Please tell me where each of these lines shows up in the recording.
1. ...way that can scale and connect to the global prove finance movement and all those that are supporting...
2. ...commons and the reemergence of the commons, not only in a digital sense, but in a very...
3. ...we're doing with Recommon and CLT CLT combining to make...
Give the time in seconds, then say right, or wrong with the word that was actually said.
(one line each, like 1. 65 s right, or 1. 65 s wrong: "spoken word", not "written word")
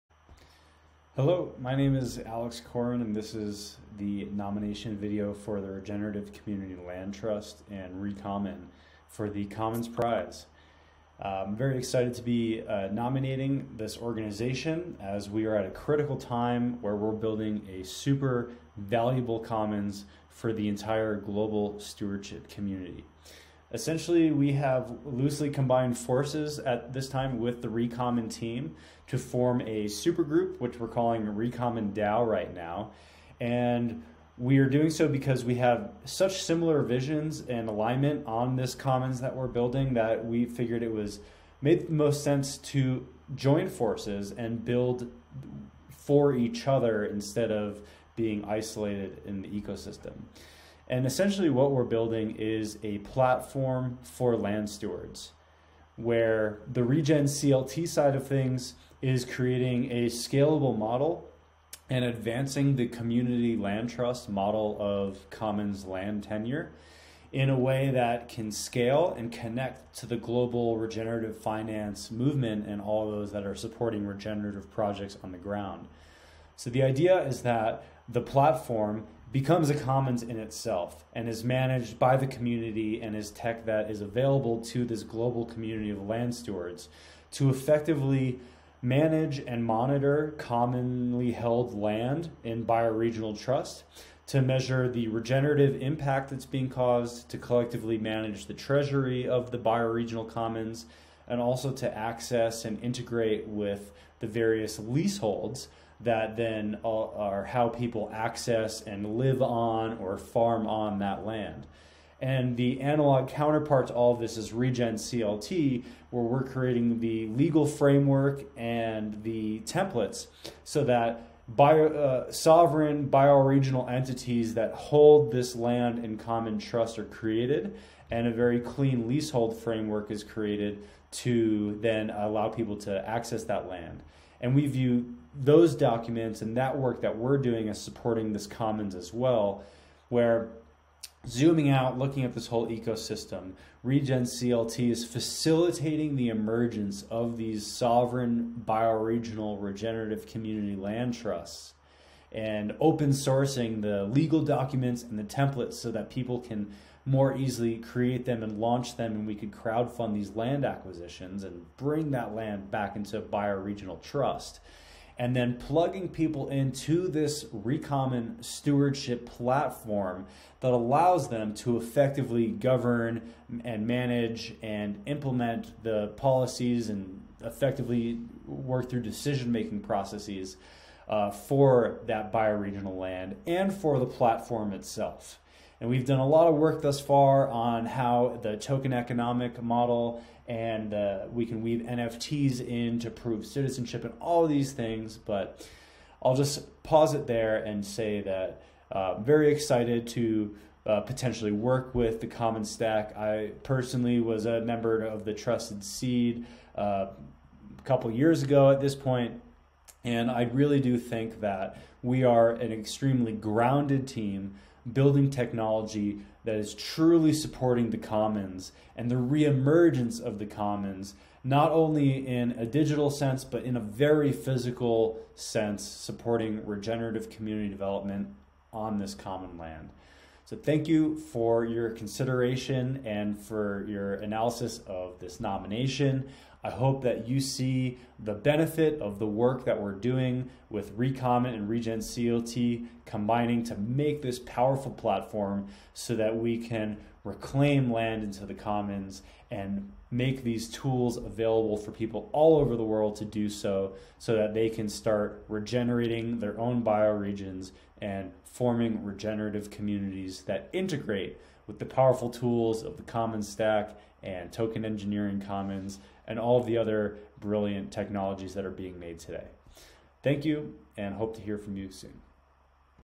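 1. 67 s wrong: "regenerative", not "prove"
2. 217 s right
3. 239 s wrong: "Regen", not "CLT".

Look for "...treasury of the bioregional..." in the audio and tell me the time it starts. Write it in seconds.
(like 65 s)
98 s.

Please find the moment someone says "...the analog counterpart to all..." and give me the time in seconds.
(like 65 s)
112 s.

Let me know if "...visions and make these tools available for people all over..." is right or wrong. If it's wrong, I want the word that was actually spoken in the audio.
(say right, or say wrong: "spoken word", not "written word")
wrong: "commons", not "visions".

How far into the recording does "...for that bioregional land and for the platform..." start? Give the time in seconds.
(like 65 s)
181 s.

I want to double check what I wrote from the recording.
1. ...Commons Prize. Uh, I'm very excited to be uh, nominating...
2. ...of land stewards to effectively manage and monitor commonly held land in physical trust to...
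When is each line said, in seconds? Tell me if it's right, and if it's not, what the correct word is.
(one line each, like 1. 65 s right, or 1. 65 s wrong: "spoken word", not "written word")
1. 9 s right
2. 85 s wrong: "bioregional", not "physical".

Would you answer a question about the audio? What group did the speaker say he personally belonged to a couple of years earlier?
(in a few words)
Trusted Seed.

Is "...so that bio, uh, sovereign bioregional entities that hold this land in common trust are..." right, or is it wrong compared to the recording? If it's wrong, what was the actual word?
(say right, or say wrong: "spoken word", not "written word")
right.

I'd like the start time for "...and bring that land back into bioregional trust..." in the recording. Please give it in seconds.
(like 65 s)
161 s.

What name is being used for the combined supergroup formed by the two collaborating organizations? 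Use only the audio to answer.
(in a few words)
Recommon DAO.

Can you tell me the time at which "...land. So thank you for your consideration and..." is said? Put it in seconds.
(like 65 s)
229 s.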